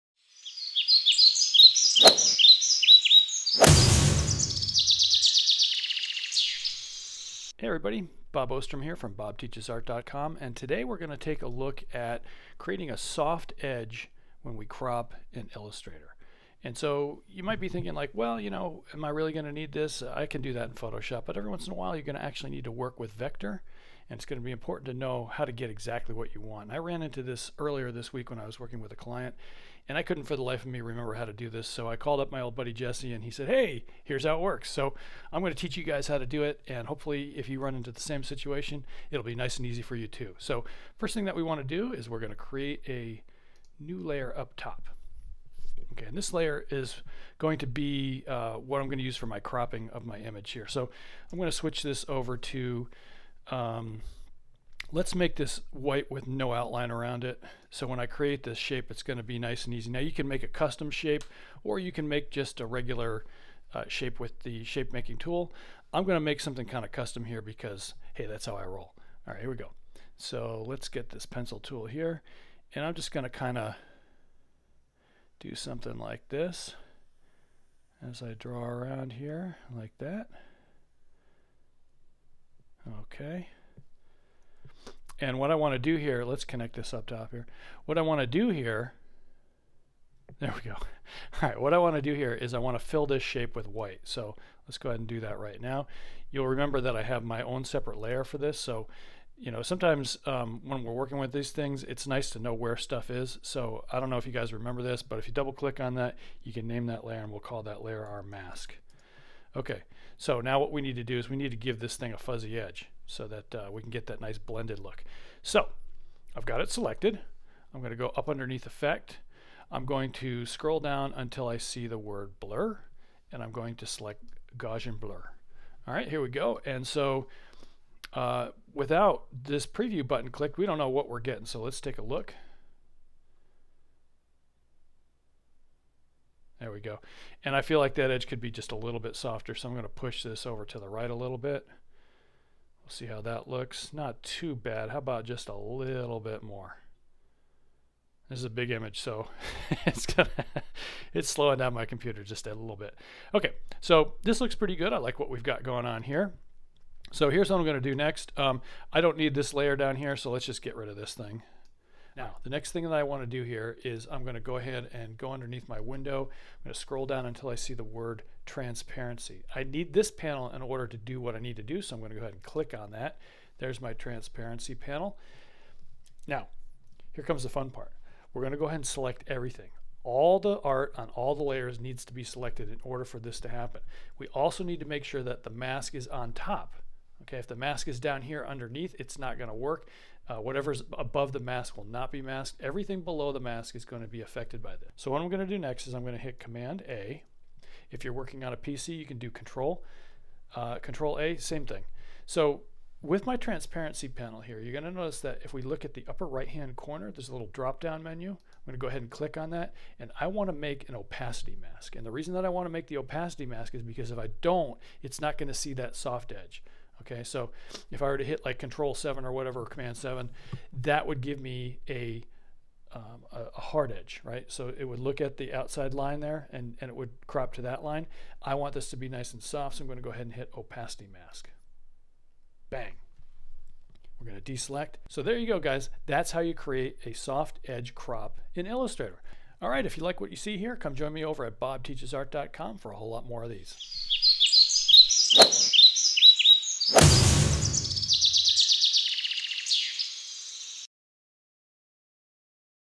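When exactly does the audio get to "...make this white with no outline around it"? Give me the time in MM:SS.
00:55.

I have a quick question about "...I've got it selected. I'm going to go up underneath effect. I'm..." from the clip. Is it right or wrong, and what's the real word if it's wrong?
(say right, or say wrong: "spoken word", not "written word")
right.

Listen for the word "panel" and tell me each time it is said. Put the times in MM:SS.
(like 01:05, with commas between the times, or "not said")
02:50, 02:54, 03:24.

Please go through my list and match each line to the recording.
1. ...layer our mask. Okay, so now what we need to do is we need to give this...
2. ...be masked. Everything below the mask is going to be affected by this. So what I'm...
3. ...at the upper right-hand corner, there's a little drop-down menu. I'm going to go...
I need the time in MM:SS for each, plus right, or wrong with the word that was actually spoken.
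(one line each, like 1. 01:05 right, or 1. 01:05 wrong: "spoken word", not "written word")
1. 01:47 right
2. 03:12 right
3. 03:25 right.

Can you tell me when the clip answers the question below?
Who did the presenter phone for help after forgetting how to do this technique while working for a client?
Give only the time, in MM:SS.
00:32.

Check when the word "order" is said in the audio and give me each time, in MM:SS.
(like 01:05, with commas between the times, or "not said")
02:50, 03:02.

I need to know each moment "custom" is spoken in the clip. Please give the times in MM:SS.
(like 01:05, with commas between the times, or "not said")
01:00, 01:06.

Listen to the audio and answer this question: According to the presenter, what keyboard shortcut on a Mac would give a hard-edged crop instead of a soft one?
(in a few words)
Command 7.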